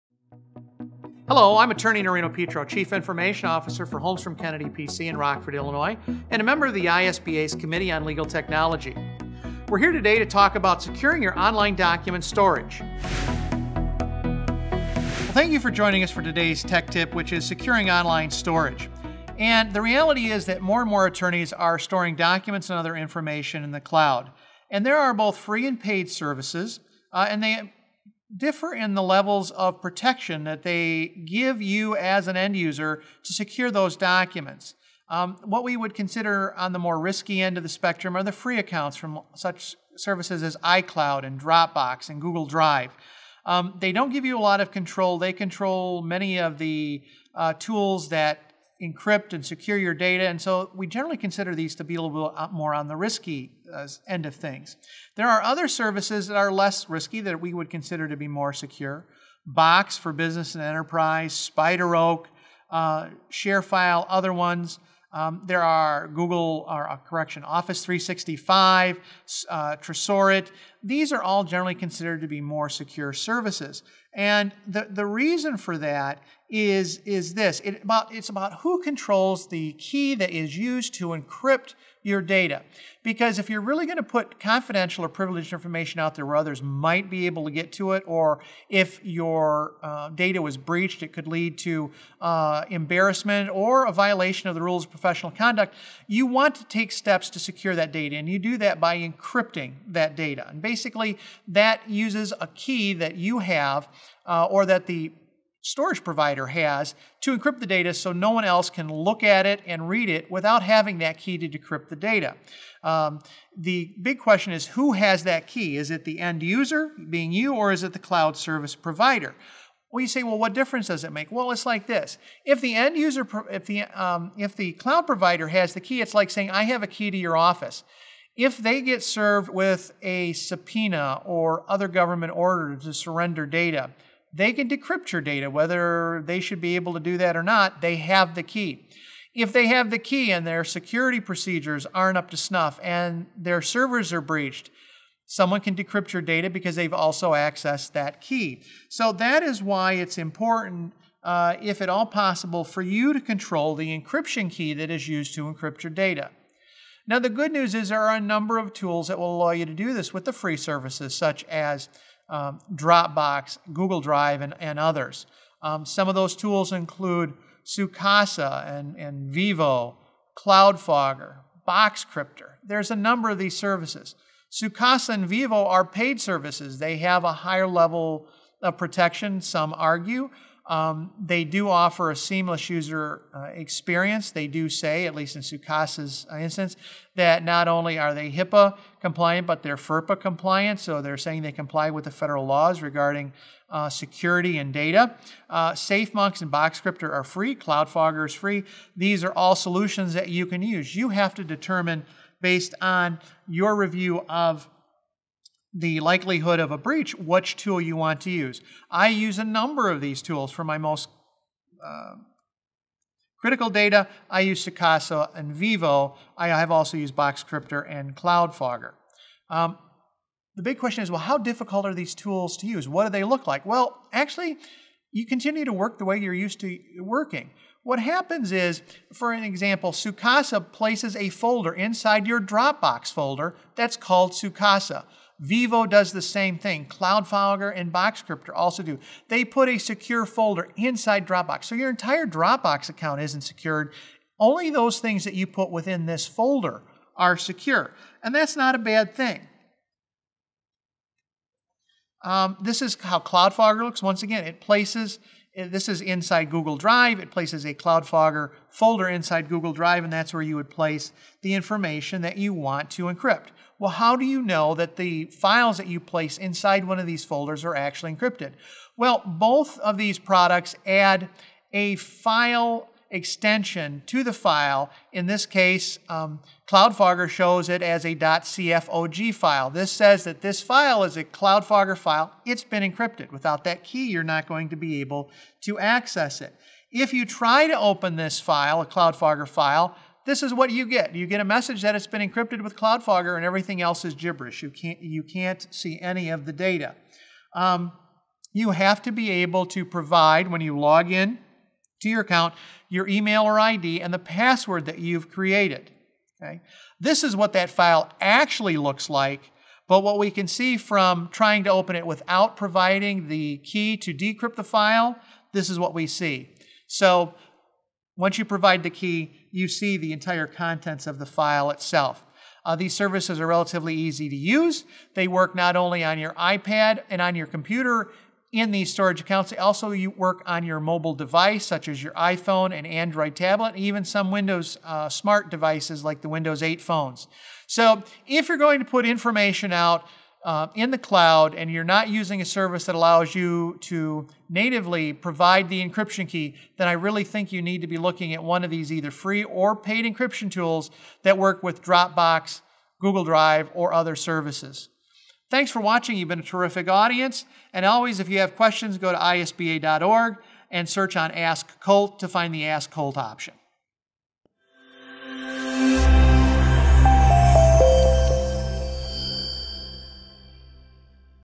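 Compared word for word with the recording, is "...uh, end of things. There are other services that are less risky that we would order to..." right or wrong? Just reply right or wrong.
wrong.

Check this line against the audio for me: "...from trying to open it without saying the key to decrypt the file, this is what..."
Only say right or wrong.
wrong.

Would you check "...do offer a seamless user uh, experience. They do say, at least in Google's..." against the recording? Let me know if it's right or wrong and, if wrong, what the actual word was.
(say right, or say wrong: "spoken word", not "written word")
wrong: "Sookasa", not "Google".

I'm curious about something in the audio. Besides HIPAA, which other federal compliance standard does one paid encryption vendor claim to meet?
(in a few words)
FERPA.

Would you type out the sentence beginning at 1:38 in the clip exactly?
And you do that by encrypting that data.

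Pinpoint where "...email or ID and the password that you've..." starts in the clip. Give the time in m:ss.
5:03.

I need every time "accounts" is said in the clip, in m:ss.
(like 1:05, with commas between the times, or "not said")
0:38, 4:02, 5:02, 5:29.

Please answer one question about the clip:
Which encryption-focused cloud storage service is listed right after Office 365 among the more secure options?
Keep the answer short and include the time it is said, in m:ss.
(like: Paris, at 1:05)
Tresorit, at 1:09.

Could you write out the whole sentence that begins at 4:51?
You get a message that it's been encrypted with CloudFogger and everything else is gibberish.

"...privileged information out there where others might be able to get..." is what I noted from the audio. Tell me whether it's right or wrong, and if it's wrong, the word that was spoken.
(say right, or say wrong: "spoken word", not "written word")
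right.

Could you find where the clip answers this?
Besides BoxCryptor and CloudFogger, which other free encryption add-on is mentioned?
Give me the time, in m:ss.
3:15.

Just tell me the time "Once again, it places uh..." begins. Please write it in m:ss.
4:14.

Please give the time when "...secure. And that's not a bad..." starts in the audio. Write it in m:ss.
4:07.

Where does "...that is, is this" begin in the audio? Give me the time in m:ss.
1:15.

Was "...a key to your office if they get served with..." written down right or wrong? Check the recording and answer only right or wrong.
right.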